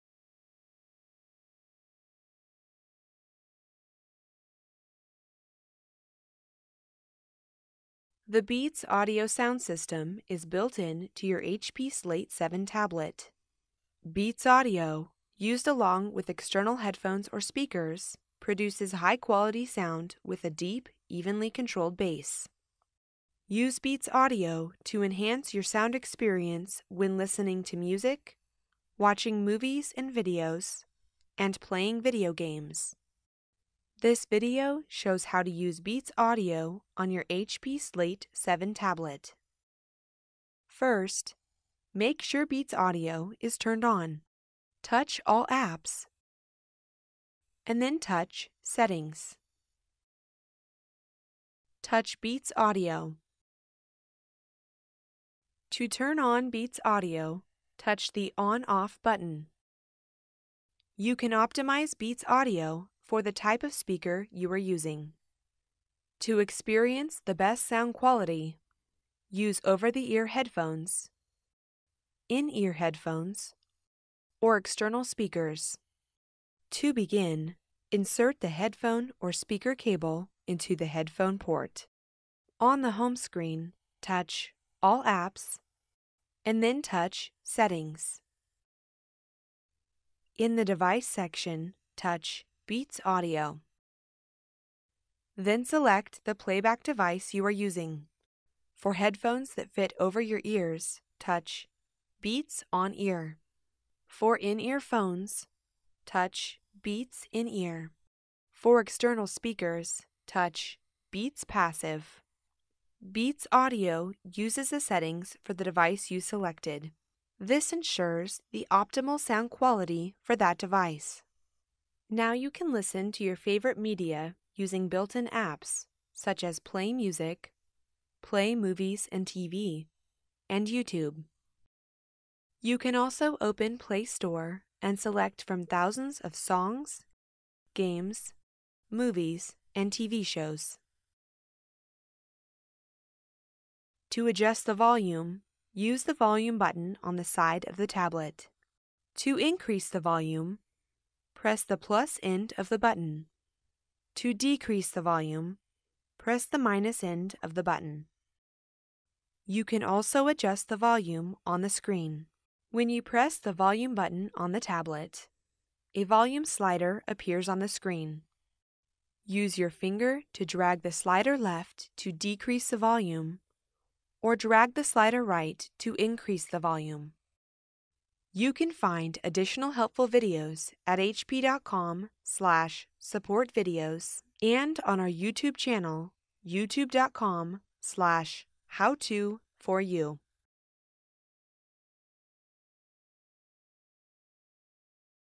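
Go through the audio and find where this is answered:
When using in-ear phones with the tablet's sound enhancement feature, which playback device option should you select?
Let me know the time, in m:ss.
1:46.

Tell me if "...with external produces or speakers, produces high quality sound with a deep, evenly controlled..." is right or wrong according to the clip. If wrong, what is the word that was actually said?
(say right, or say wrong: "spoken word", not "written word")
wrong: "headphones", not "produces".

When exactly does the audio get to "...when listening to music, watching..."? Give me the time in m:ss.
0:26.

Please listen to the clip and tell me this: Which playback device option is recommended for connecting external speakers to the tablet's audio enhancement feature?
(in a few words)
Beats Passive.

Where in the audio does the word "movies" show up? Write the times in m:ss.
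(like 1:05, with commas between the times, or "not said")
0:29, 2:08, 2:18.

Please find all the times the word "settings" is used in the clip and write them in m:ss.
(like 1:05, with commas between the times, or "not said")
0:48, 1:27, 1:54.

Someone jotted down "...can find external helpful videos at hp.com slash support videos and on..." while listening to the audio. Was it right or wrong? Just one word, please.
wrong.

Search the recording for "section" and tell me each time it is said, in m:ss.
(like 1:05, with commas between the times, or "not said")
1:31.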